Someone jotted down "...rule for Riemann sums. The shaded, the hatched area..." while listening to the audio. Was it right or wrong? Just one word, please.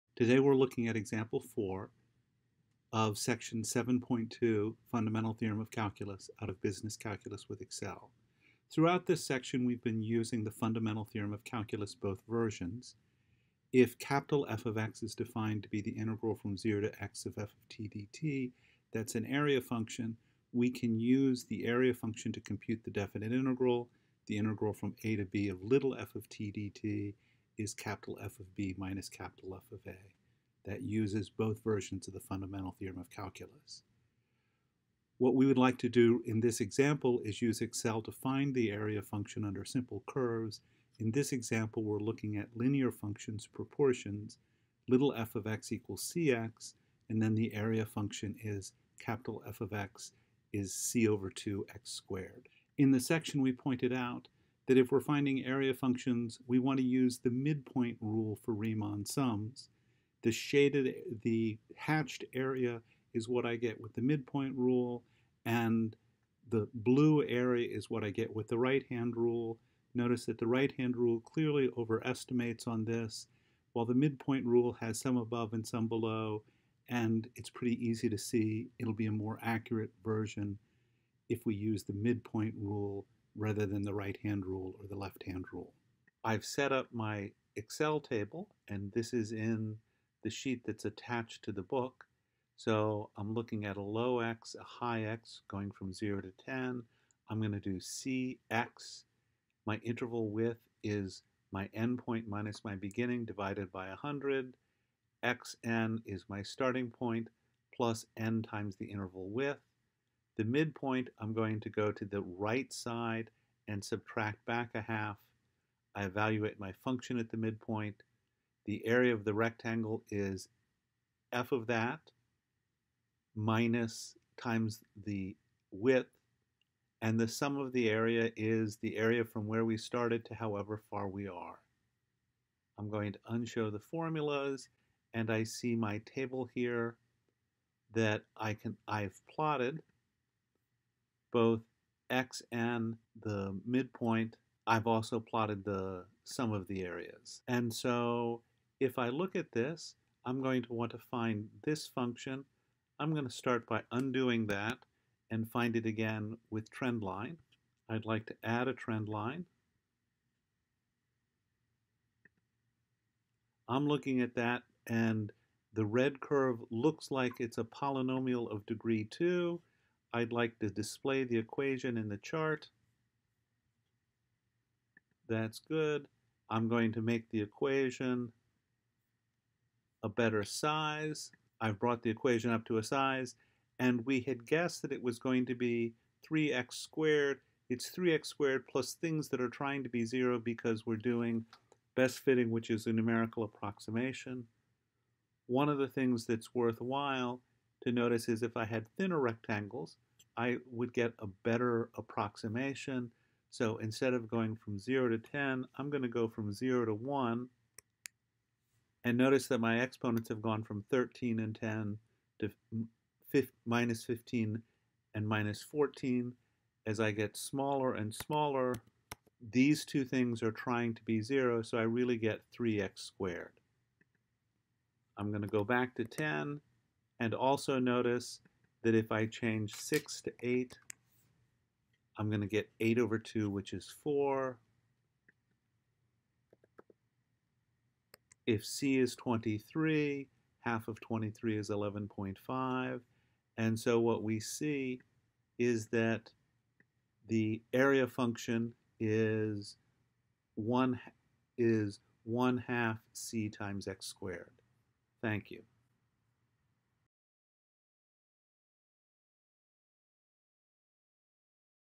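right.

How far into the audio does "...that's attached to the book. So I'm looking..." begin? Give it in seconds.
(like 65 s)
90 s.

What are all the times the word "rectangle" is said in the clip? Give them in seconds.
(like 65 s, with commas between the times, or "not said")
119 s, 199 s.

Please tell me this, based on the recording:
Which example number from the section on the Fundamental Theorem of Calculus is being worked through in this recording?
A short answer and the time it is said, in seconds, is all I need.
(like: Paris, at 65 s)
4, at 0 s.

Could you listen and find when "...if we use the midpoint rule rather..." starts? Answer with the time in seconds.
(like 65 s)
81 s.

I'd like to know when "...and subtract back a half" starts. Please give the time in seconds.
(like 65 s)
113 s.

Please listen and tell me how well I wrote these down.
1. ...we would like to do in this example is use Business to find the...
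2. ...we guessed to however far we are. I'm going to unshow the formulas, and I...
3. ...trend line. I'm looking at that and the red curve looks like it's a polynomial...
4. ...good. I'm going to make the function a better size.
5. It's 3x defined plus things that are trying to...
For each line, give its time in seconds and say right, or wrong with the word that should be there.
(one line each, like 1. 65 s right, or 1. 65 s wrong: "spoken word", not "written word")
1. 35 s wrong: "Excel", not "Business"
2. 129 s wrong: "started", not "guessed"
3. 158 s right
4. 175 s wrong: "equation", not "function"
5. 187 s wrong: "squared", not "defined".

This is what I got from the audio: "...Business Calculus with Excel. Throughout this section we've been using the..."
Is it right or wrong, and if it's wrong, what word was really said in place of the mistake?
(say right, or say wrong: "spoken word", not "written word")
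right.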